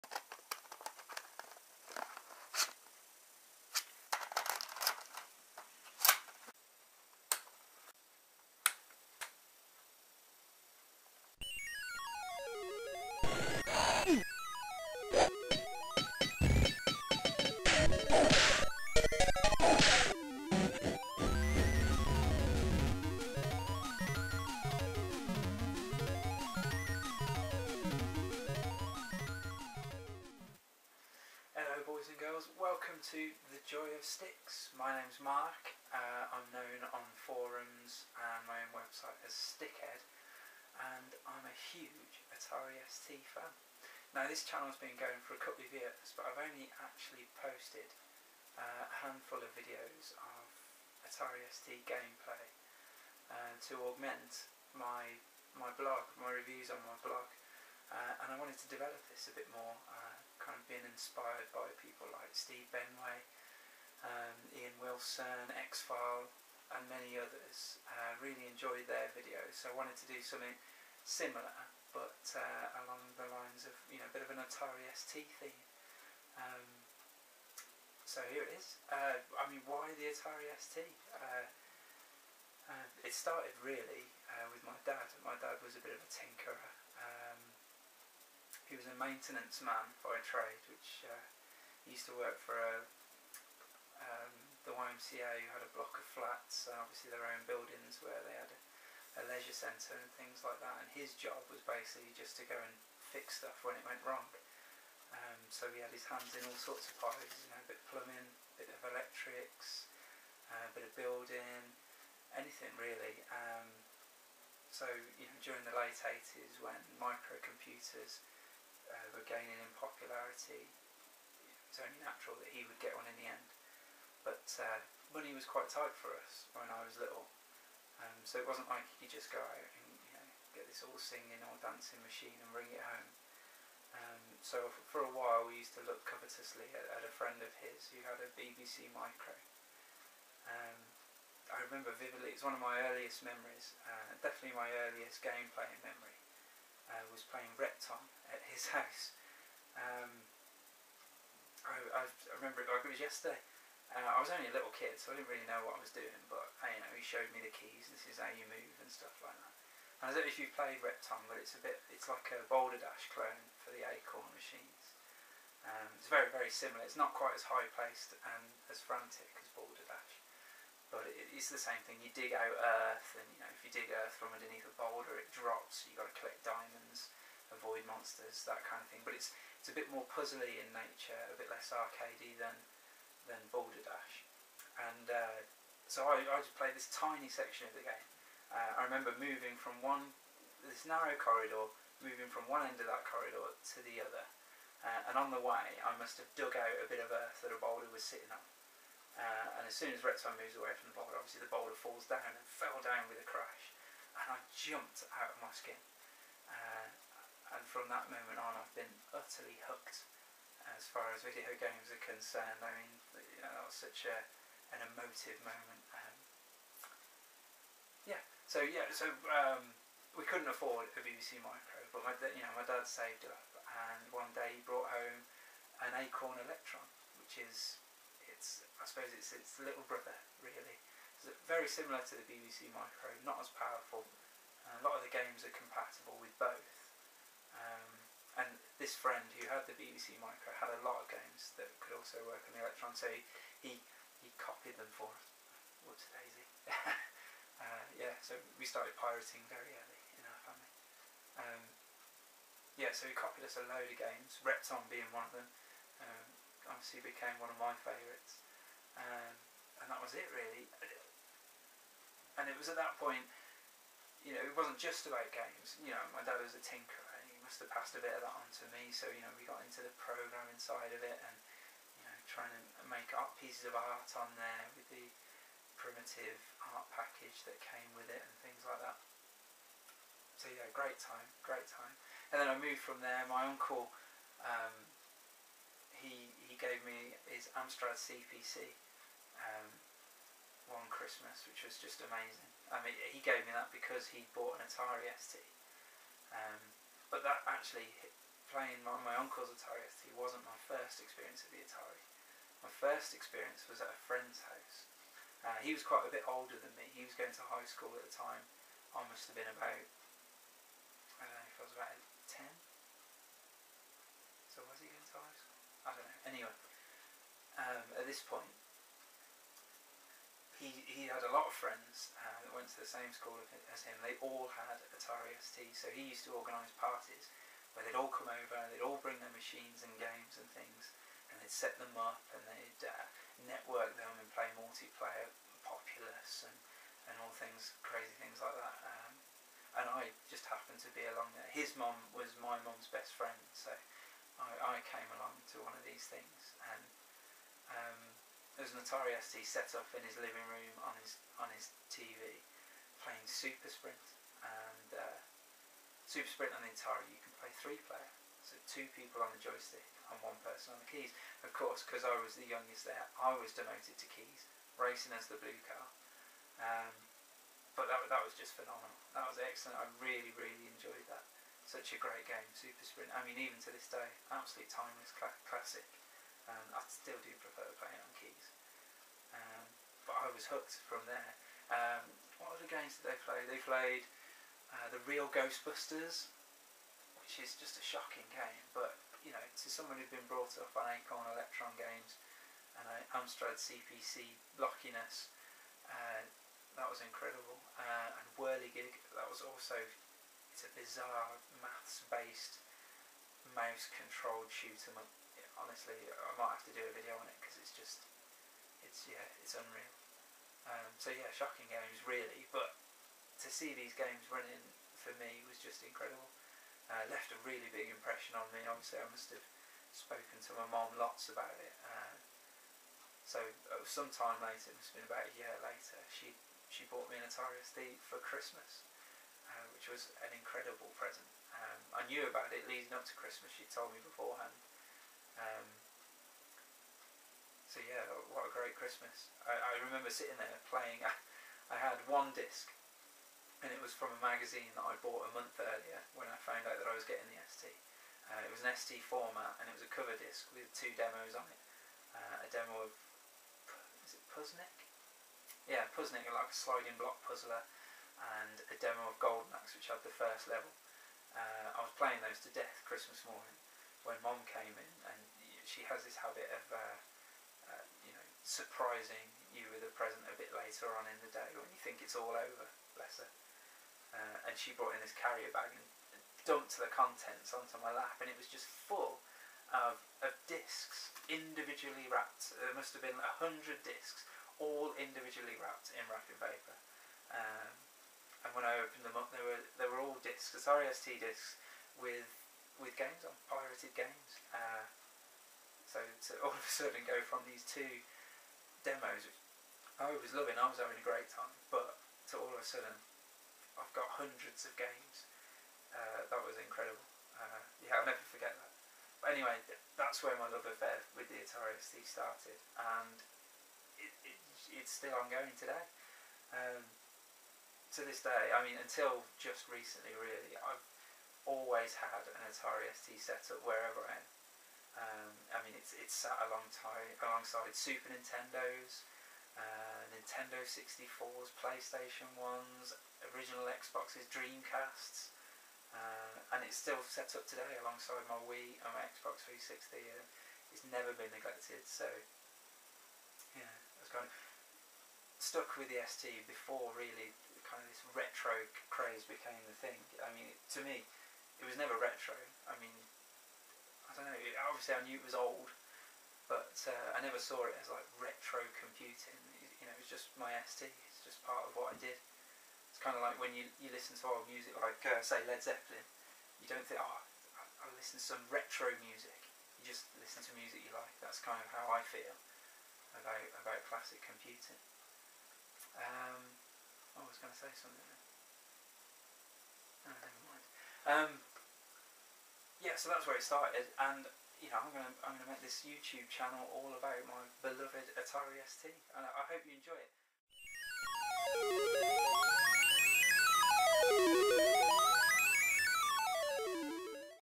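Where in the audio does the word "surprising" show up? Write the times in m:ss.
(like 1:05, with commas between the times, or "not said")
7:48.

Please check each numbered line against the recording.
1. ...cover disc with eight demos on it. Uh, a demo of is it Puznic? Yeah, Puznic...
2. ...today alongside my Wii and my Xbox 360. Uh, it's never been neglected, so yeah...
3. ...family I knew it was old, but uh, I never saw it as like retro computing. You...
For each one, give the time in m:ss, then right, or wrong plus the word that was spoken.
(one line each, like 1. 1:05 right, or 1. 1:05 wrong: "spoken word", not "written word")
1. 7:29 wrong: "two", not "eight"
2. 8:57 right
3. 9:14 wrong: "obviously", not "family".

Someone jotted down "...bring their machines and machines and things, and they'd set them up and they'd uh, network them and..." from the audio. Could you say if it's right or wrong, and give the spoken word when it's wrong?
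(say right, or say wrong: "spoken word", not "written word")
wrong: "games", not "machines".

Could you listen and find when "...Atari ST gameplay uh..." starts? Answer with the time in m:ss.
0:51.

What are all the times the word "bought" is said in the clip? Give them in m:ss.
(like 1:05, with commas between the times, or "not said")
4:54, 7:06, 7:24.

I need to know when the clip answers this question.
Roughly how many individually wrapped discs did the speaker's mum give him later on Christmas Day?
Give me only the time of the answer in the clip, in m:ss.
8:03.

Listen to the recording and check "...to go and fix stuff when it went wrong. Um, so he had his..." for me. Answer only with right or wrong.
right.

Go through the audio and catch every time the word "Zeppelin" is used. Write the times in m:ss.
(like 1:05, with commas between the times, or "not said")
9:25.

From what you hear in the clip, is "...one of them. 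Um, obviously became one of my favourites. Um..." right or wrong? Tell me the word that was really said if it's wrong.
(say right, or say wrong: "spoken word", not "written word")
right.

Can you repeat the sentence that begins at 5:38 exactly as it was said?
Um, and I just happened to be along there.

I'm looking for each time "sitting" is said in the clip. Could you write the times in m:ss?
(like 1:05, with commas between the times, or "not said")
3:18, 7:20.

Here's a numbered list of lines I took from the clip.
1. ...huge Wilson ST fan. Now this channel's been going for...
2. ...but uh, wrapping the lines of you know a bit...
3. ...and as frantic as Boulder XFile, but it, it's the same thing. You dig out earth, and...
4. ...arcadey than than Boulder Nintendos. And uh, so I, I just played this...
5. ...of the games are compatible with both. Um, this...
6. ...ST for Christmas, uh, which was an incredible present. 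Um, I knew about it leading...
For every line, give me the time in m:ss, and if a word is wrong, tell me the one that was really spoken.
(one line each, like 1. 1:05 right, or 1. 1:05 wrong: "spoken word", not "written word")
1. 0:41 wrong: "Atari", not "Wilson"
2. 1:11 wrong: "along", not "wrapping"
3. 2:48 wrong: "Dash", not "XFile"
4. 3:01 wrong: "Dash", not "Nintendos"
5. 3:55 right
6. 7:07 right.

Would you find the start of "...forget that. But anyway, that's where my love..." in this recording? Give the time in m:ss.
8:28.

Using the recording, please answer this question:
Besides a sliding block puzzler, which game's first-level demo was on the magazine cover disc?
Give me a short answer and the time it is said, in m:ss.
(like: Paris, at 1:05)
Golden Axe, at 7:39.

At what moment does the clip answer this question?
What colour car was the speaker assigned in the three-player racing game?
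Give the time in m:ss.
6:05.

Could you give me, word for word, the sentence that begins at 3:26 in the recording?
Uh, and from that moment on, I've been utterly hooked as far as video games are concerned.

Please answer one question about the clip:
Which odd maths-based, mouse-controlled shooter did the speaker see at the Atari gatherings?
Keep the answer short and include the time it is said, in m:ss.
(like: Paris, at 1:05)
Whirligig, at 6:38.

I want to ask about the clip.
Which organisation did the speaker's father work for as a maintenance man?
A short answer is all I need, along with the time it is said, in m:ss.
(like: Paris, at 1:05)
YMCA, at 1:35.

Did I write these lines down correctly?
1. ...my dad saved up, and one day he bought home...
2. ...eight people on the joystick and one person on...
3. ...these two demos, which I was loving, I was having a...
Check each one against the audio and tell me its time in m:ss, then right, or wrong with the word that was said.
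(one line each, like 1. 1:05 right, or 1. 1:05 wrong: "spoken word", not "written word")
1. 3:42 wrong: "brought", not "bought"
2. 5:58 wrong: "two", not "eight"
3. 8:17 right.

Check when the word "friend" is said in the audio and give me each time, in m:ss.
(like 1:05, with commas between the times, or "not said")
2:17, 3:58, 5:04, 5:21, 5:43.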